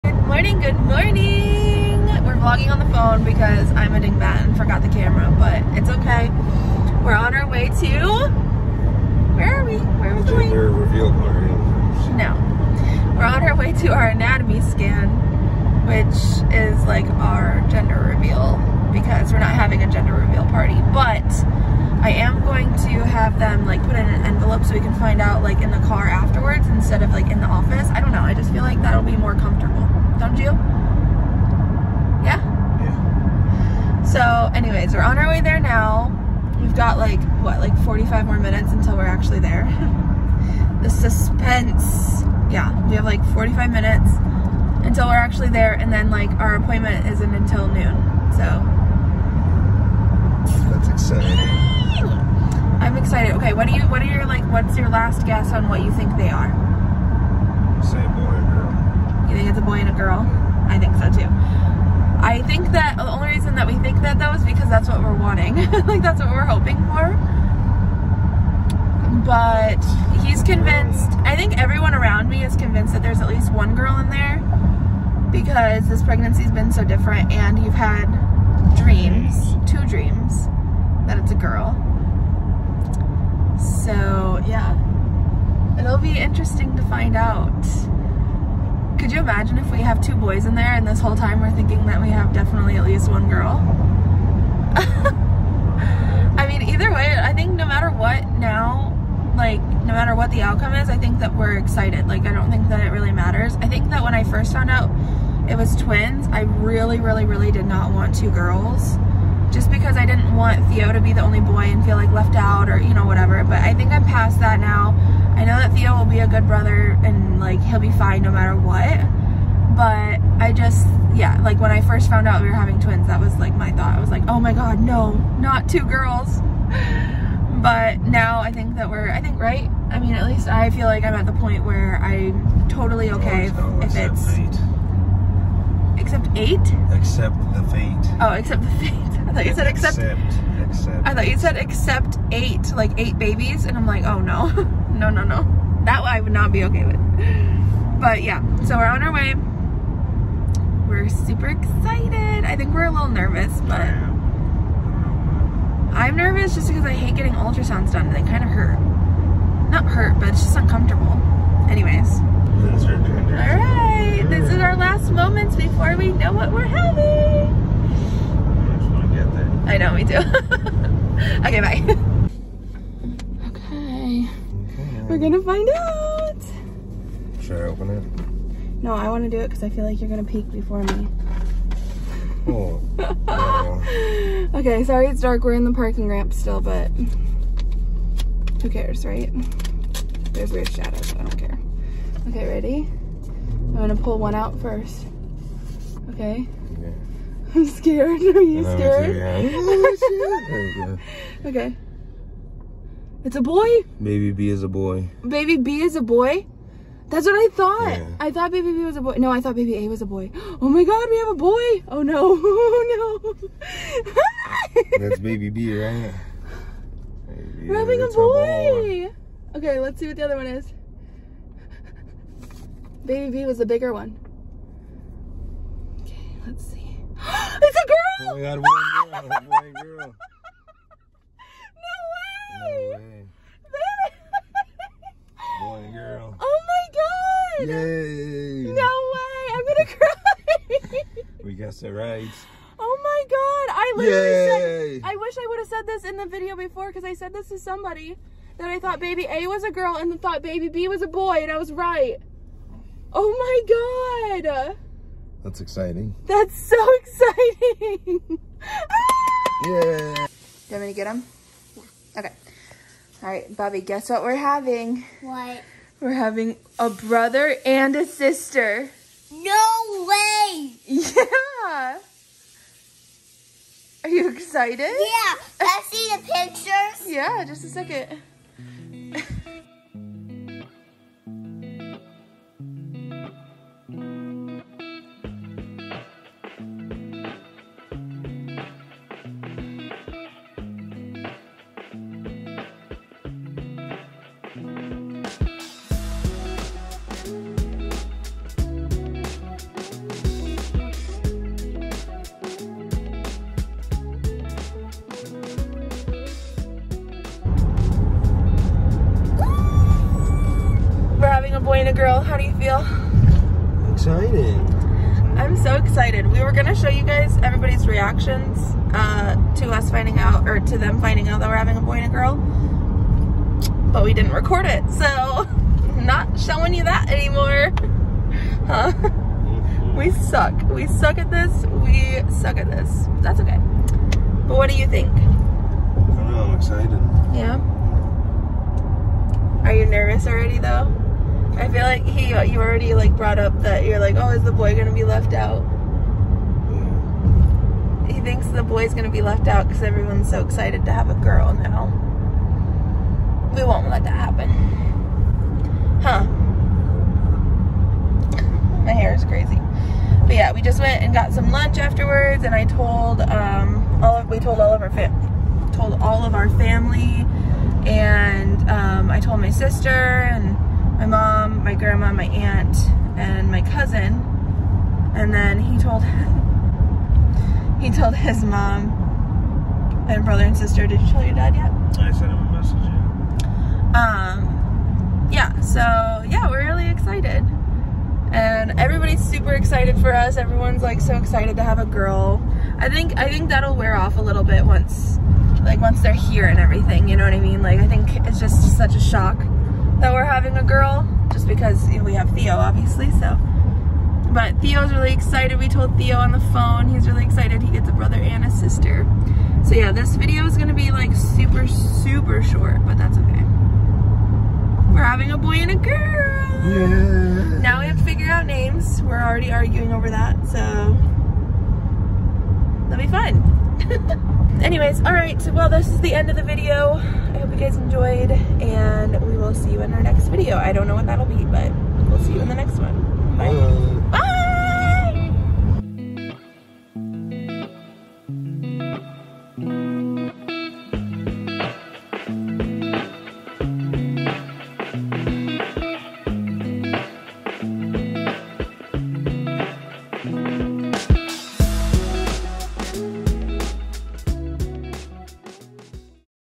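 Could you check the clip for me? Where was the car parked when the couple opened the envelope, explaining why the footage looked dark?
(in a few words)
parking ramp.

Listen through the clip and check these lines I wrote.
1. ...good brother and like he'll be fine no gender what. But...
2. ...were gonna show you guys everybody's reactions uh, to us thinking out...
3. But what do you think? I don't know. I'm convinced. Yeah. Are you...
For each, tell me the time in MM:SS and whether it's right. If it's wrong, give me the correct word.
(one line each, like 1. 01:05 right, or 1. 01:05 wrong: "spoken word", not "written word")
1. 01:56 wrong: "matter", not "gender"
2. 05:16 wrong: "finding", not "thinking"
3. 05:34 wrong: "excited", not "convinced".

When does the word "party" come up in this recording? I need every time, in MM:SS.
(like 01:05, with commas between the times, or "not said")
00:11, 00:20.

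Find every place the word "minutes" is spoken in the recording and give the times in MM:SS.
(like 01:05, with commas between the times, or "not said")
00:38, 00:43.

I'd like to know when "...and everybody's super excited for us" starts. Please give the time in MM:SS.
06:28.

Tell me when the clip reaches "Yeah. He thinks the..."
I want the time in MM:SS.
05:46.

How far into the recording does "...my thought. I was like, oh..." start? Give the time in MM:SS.
02:03.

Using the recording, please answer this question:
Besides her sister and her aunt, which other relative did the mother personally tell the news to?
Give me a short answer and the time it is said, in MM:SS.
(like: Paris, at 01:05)
cousin, at 06:13.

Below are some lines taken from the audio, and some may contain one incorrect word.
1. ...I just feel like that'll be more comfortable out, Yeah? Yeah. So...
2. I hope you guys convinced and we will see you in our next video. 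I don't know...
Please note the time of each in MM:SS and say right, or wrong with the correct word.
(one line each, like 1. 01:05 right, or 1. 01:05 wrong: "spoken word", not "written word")
1. 00:28 right
2. 07:07 wrong: "enjoyed", not "convinced".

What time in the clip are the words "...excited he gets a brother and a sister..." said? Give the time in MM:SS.
06:47.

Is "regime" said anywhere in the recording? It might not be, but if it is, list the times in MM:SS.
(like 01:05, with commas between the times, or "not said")
not said.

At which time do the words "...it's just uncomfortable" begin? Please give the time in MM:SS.
02:40.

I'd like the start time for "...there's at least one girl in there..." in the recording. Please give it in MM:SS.
01:13.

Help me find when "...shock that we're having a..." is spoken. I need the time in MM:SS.
06:38.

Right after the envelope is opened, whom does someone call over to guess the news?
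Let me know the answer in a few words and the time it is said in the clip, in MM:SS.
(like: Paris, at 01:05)
Bobby, at 04:23.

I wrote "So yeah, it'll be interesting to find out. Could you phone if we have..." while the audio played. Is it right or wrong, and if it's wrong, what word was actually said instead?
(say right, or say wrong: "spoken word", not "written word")
wrong: "imagine", not "phone".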